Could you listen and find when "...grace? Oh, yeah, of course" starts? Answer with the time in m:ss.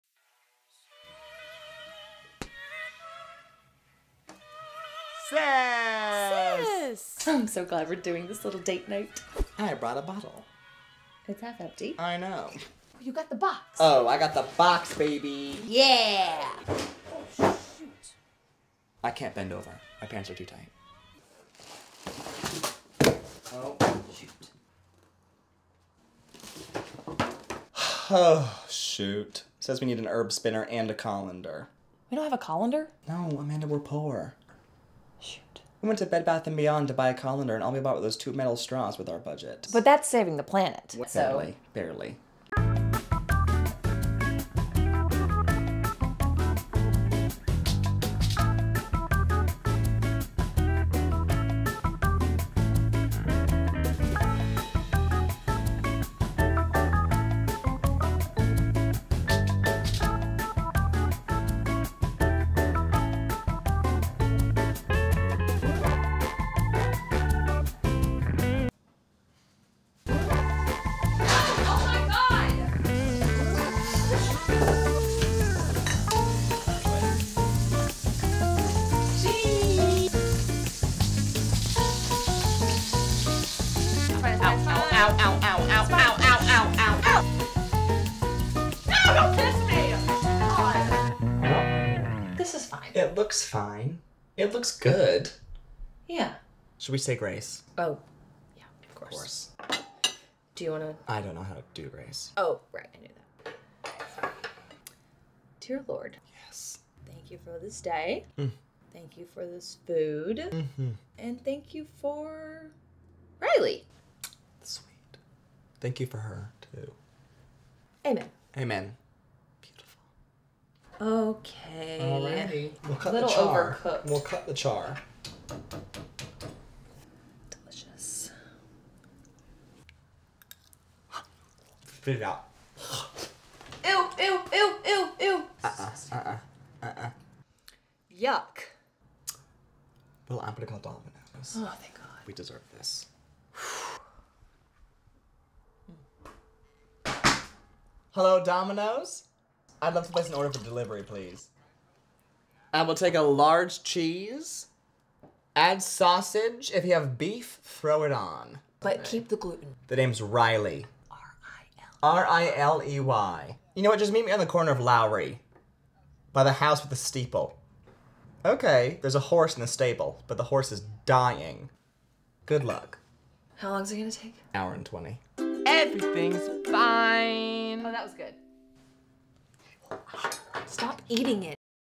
1:37.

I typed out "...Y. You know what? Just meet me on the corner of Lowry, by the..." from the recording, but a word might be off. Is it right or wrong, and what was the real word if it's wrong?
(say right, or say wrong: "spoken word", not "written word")
right.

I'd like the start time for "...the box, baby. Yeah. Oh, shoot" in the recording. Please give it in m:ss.
0:14.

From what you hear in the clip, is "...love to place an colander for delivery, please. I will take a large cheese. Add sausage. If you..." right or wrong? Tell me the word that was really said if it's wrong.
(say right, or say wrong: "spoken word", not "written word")
wrong: "order", not "colander".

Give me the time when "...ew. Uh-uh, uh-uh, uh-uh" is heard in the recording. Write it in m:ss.
2:15.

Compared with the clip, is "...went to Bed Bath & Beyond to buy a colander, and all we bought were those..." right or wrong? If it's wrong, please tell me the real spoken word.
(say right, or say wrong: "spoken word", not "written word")
right.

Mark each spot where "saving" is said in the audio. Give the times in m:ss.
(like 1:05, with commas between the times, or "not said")
0:40.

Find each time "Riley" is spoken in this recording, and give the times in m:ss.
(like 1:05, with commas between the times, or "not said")
1:53, 2:40.